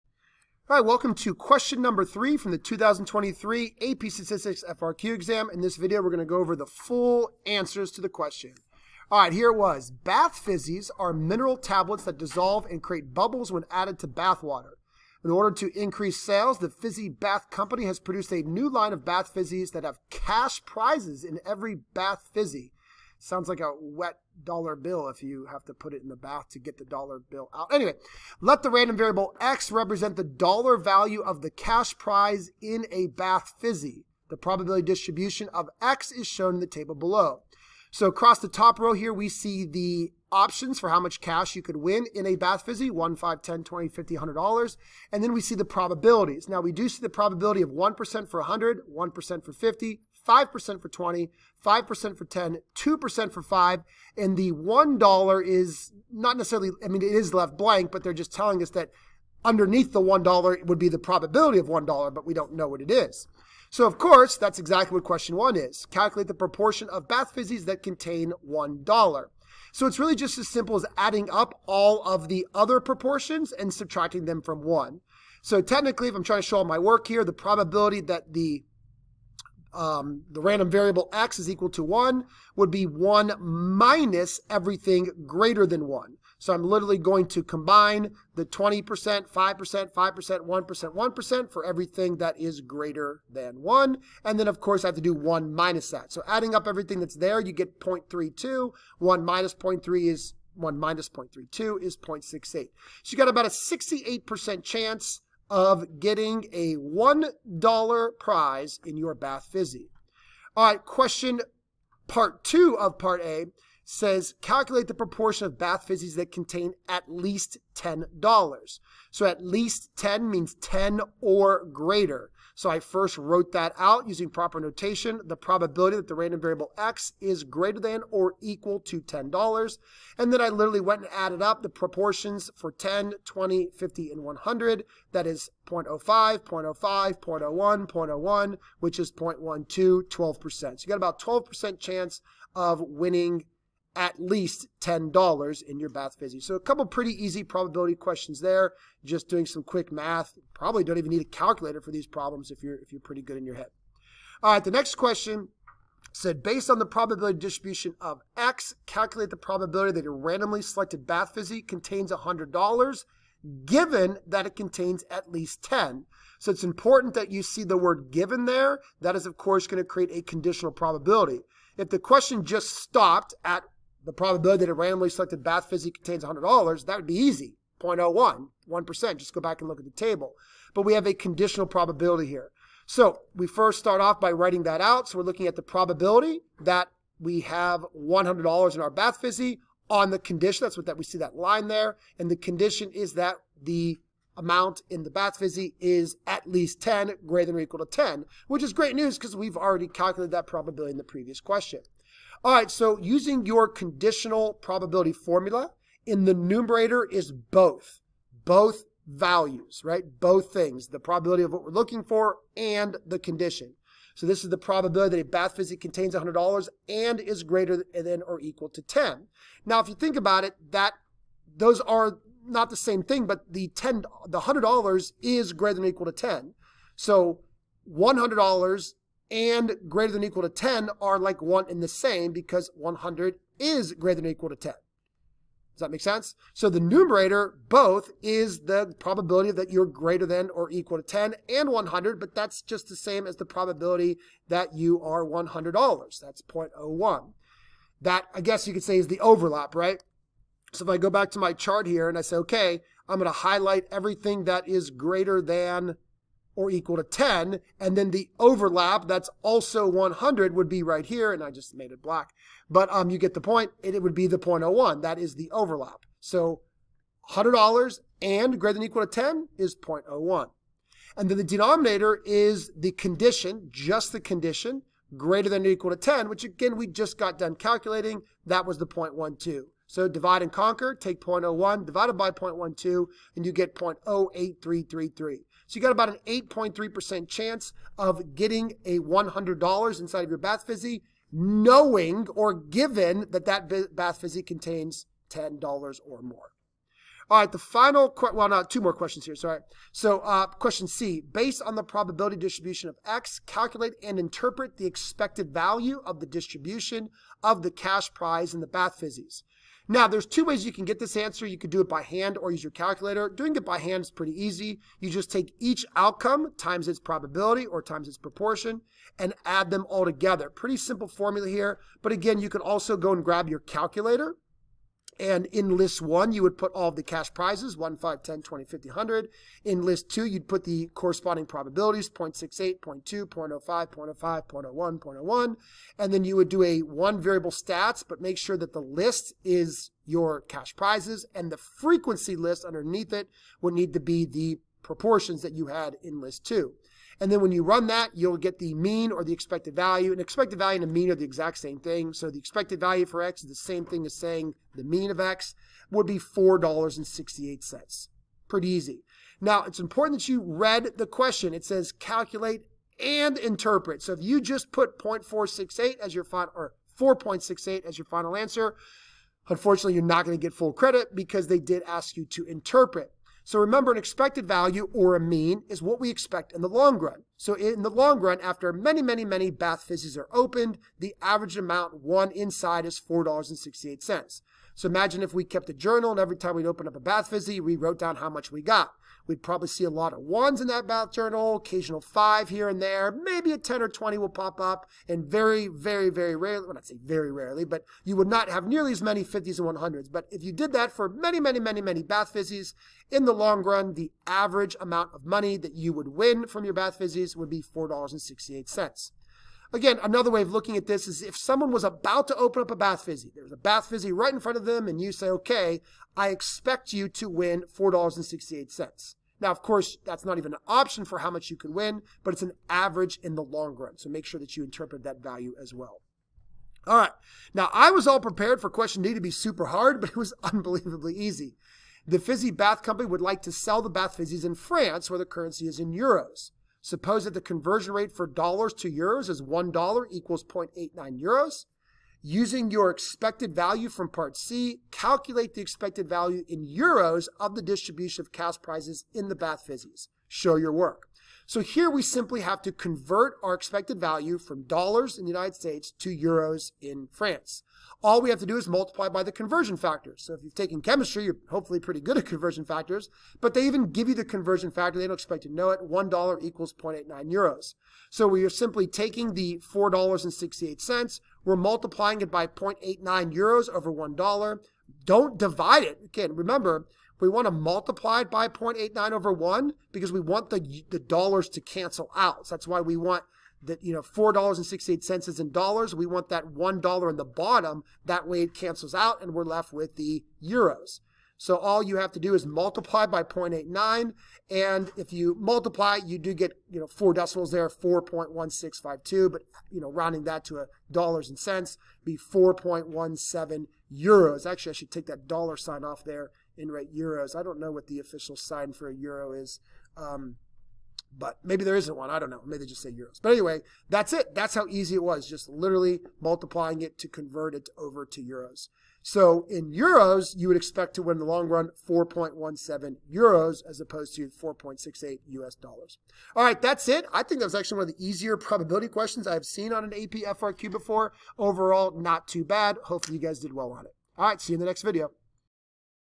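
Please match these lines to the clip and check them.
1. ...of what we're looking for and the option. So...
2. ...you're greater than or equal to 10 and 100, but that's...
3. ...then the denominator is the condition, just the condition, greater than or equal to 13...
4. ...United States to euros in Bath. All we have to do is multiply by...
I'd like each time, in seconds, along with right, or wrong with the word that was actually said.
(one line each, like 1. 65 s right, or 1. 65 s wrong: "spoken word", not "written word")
1. 211 s wrong: "condition", not "option"
2. 239 s right
3. 271 s wrong: "10", not "13"
4. 455 s wrong: "France", not "Bath".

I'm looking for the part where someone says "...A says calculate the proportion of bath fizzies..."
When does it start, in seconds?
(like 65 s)
113 s.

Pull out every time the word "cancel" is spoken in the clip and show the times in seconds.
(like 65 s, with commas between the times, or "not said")
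481 s, 488 s.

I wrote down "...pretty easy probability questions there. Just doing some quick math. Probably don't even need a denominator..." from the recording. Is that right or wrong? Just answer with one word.
wrong.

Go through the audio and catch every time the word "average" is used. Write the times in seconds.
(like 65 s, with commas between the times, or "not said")
381 s, 404 s, 422 s.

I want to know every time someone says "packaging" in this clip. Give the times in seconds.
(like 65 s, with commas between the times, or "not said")
not said.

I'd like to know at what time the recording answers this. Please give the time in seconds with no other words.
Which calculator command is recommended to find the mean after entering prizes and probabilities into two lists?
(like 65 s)
336 s.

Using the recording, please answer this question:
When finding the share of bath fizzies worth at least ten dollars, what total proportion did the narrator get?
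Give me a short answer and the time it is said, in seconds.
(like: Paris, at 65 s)
0.12, at 139 s.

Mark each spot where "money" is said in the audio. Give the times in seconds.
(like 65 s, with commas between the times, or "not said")
405 s.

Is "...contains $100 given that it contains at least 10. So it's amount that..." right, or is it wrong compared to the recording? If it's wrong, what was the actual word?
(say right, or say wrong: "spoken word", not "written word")
wrong: "important", not "amount".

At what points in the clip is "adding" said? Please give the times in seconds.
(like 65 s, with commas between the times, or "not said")
70 s, 96 s.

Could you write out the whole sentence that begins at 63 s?
So, of course, that's exactly what question one is.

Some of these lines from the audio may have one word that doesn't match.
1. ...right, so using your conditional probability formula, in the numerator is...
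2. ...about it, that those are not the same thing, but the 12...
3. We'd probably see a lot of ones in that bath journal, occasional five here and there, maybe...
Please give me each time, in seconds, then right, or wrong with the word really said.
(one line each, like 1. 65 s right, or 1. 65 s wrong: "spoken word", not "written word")
1. 202 s right
2. 220 s wrong: "10", not "12"
3. 389 s right.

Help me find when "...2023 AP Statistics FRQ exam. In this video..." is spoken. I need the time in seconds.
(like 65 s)
2 s.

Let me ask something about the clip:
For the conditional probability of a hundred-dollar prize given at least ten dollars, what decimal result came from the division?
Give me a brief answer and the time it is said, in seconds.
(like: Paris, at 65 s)
0.08333, at 283 s.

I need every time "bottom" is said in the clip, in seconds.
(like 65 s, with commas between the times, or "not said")
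487 s.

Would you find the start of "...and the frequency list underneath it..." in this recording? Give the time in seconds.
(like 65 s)
341 s.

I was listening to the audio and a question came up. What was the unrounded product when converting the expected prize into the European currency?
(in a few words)
4.1652.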